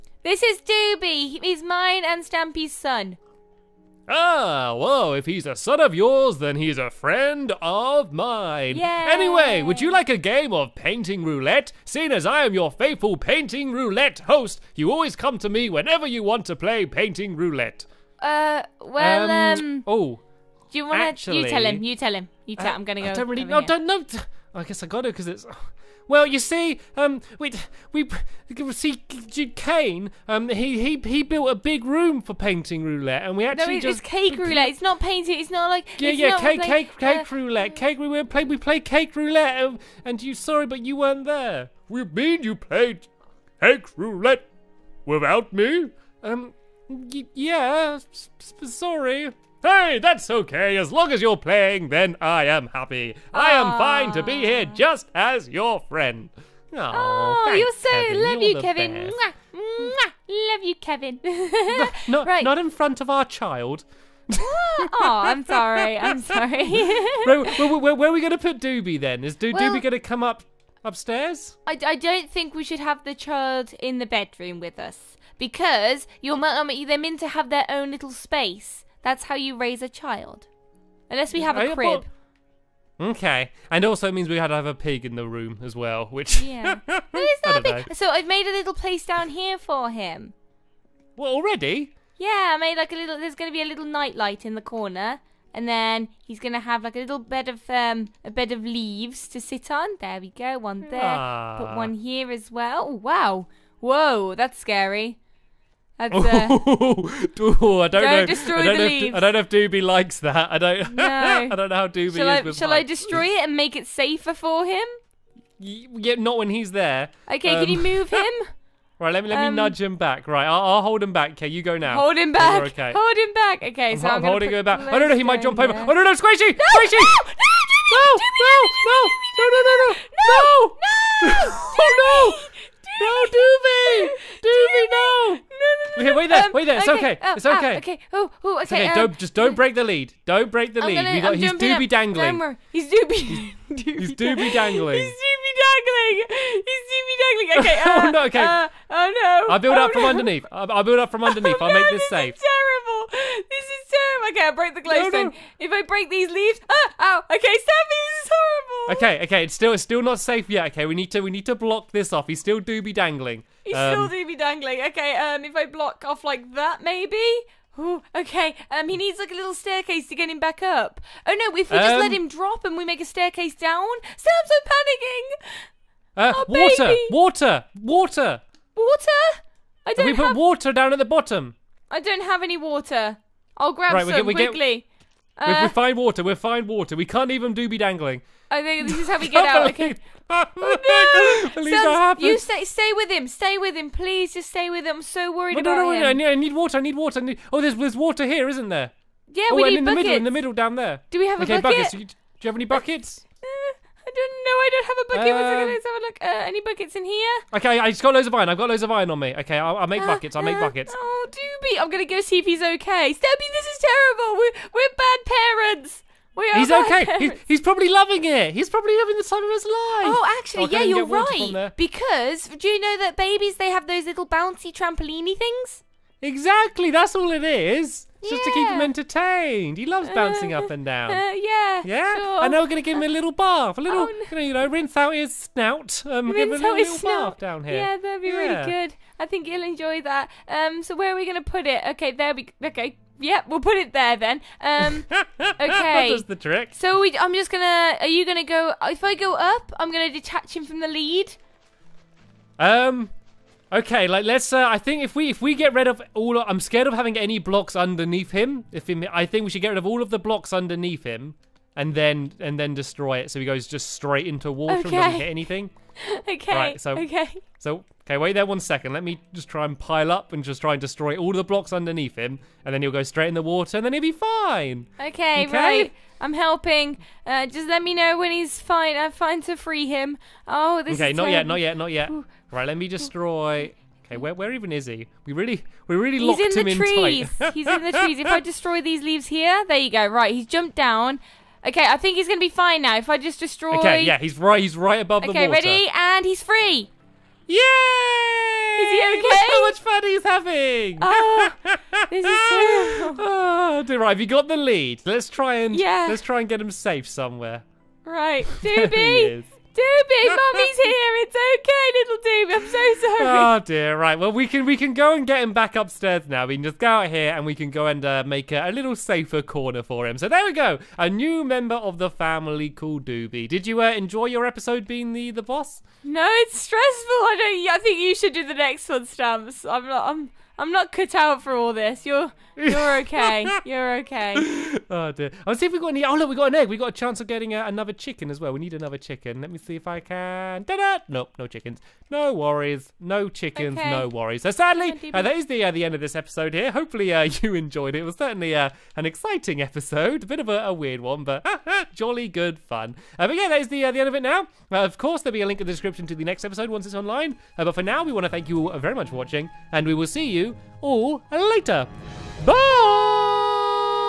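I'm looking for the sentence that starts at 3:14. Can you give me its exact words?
I'm so worried no, about no, no, him.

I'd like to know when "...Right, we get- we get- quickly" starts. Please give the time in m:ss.
3:03.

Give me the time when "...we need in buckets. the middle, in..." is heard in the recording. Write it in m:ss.
3:19.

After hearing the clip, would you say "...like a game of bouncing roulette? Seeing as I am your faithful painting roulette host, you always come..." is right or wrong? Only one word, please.
wrong.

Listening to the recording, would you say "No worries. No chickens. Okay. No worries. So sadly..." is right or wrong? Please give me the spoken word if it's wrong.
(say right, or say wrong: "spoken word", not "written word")
right.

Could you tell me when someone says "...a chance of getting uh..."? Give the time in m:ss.
5:36.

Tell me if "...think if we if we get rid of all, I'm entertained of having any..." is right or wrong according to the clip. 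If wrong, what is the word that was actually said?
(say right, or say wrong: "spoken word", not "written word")
wrong: "scared", not "entertained".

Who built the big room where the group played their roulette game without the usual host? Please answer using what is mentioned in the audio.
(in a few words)
Kane.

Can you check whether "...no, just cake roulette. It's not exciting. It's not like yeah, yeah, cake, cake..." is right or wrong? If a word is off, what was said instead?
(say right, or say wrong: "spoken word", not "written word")
wrong: "painting", not "exciting".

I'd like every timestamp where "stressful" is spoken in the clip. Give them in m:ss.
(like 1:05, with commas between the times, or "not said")
5:26.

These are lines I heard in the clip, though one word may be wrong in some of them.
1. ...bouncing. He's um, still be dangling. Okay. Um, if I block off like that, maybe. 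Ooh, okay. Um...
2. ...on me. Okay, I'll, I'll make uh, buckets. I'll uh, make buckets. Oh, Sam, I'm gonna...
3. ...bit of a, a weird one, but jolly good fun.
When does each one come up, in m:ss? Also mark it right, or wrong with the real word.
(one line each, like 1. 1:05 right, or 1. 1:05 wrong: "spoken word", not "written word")
1. 2:42 wrong: "dangling", not "bouncing"
2. 3:29 wrong: "Doobie", not "Sam"
3. 5:50 right.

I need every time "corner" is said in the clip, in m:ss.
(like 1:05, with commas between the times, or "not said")
1:34, 5:19.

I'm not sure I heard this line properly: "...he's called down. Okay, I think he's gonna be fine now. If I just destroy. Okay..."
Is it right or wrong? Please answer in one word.
wrong.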